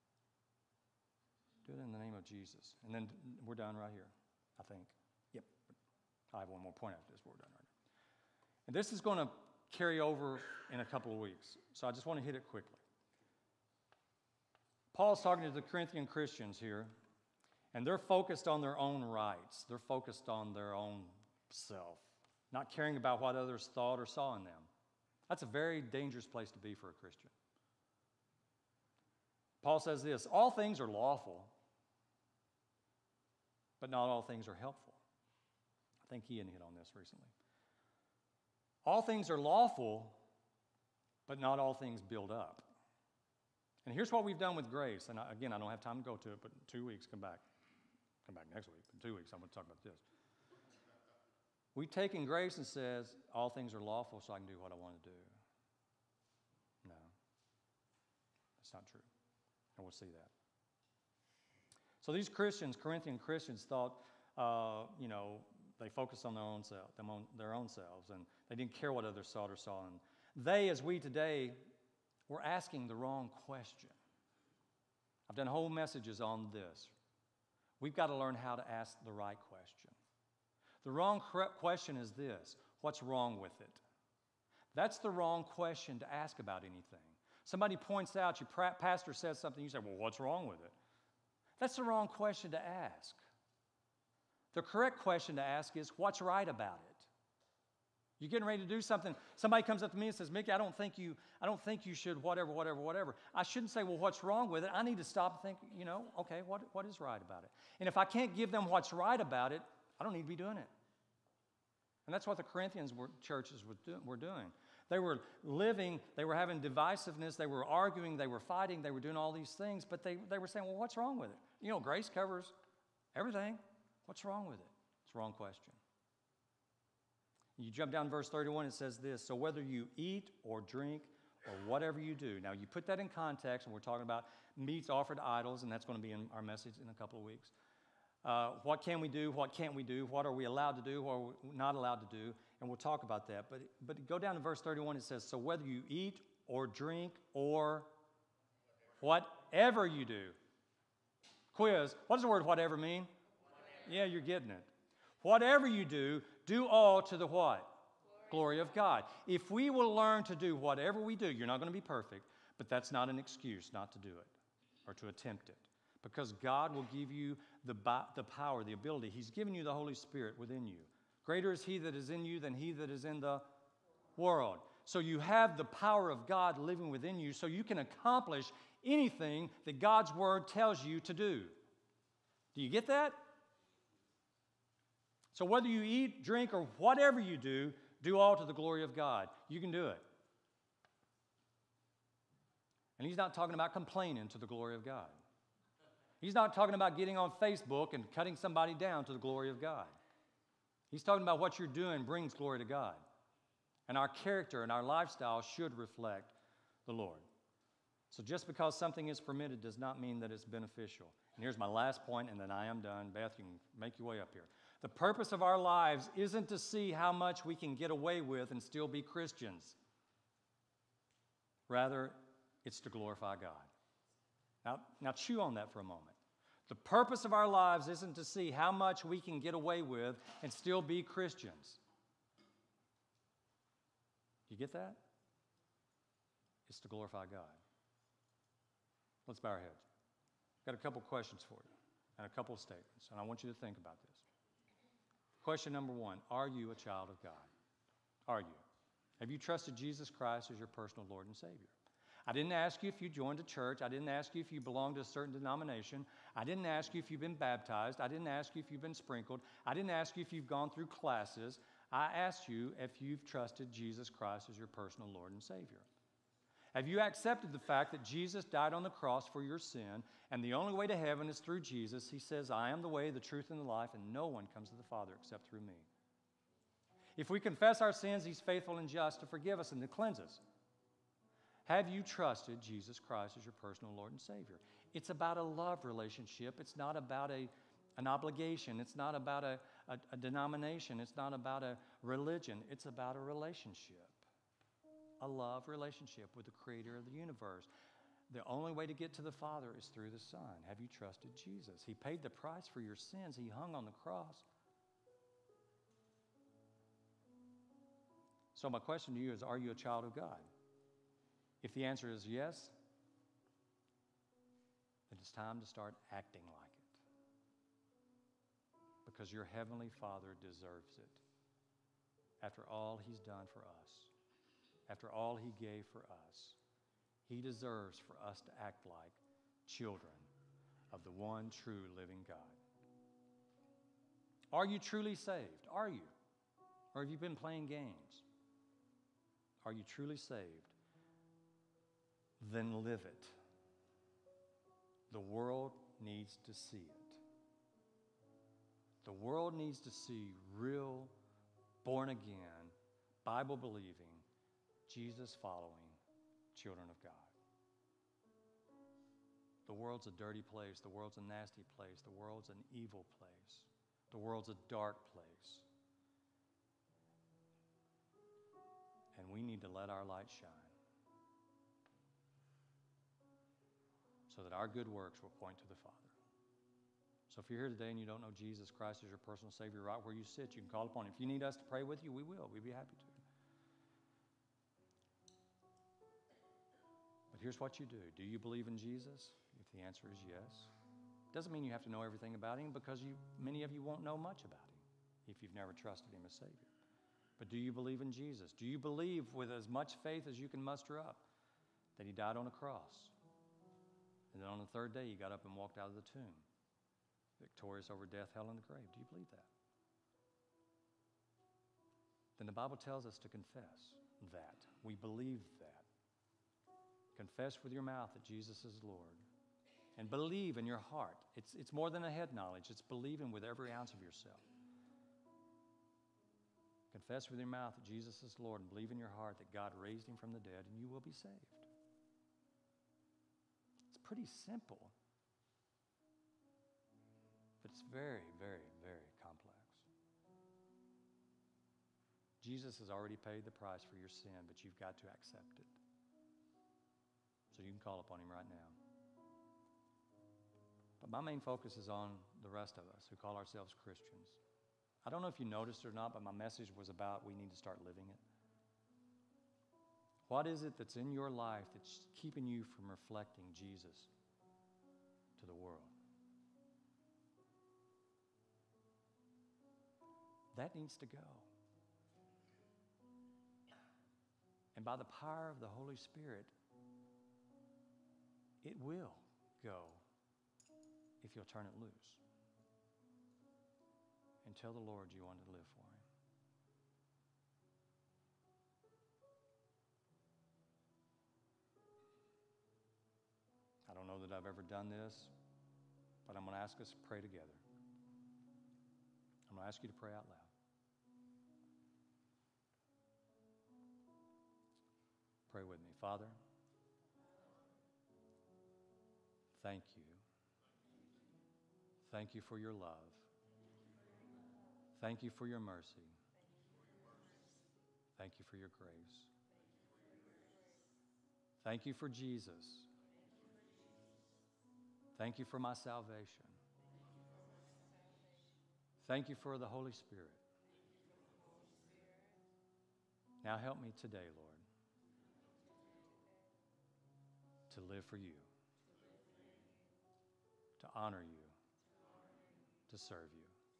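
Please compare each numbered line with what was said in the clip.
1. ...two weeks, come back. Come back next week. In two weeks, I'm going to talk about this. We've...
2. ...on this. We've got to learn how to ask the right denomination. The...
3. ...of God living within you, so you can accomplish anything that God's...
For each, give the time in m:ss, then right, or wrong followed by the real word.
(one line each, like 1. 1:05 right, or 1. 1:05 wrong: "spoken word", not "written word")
1. 0:46 right
2. 1:16 wrong: "question", not "denomination"
3. 2:56 right.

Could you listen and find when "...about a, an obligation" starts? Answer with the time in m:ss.
4:46.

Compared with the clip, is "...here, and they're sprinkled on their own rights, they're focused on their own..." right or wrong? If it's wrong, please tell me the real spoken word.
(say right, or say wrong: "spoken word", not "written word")
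wrong: "focused", not "sprinkled".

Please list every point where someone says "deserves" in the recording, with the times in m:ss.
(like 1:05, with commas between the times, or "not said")
5:20, 5:27.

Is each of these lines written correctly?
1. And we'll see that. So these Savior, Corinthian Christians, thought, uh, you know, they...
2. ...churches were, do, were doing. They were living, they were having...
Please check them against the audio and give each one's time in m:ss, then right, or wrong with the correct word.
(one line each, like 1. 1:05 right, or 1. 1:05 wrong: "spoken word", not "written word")
1. 0:59 wrong: "Christians", not "Savior"
2. 1:53 right.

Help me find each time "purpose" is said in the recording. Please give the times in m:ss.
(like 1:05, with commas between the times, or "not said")
3:34, 3:46.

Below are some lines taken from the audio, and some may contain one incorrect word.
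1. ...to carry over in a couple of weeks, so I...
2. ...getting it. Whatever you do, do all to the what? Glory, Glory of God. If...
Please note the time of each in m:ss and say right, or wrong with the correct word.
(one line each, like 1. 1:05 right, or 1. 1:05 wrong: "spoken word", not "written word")
1. 0:09 right
2. 2:34 right.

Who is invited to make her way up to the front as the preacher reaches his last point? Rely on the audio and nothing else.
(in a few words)
Beth.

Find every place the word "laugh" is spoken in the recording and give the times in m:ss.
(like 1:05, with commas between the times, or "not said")
not said.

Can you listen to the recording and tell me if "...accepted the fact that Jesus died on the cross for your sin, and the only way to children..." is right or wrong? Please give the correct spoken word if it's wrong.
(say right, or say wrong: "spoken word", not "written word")
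wrong: "heaven", not "children".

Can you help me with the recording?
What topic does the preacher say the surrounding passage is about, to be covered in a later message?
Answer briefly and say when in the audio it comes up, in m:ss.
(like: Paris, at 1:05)
Meats offered to idols, at 2:14.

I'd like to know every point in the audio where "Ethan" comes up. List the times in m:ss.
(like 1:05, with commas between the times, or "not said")
not said.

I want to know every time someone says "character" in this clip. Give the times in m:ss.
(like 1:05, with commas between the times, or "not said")
3:24.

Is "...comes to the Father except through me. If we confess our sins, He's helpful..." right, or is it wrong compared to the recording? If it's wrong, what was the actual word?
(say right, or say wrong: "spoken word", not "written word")
wrong: "faithful", not "helpful".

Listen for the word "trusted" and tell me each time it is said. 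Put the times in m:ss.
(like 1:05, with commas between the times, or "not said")
4:09, 4:23, 4:42, 5:00, 6:35.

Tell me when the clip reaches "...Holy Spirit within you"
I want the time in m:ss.
2:49.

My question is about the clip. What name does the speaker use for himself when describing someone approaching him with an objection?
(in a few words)
Mickey.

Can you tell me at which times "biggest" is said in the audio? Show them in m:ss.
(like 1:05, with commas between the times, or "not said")
not said.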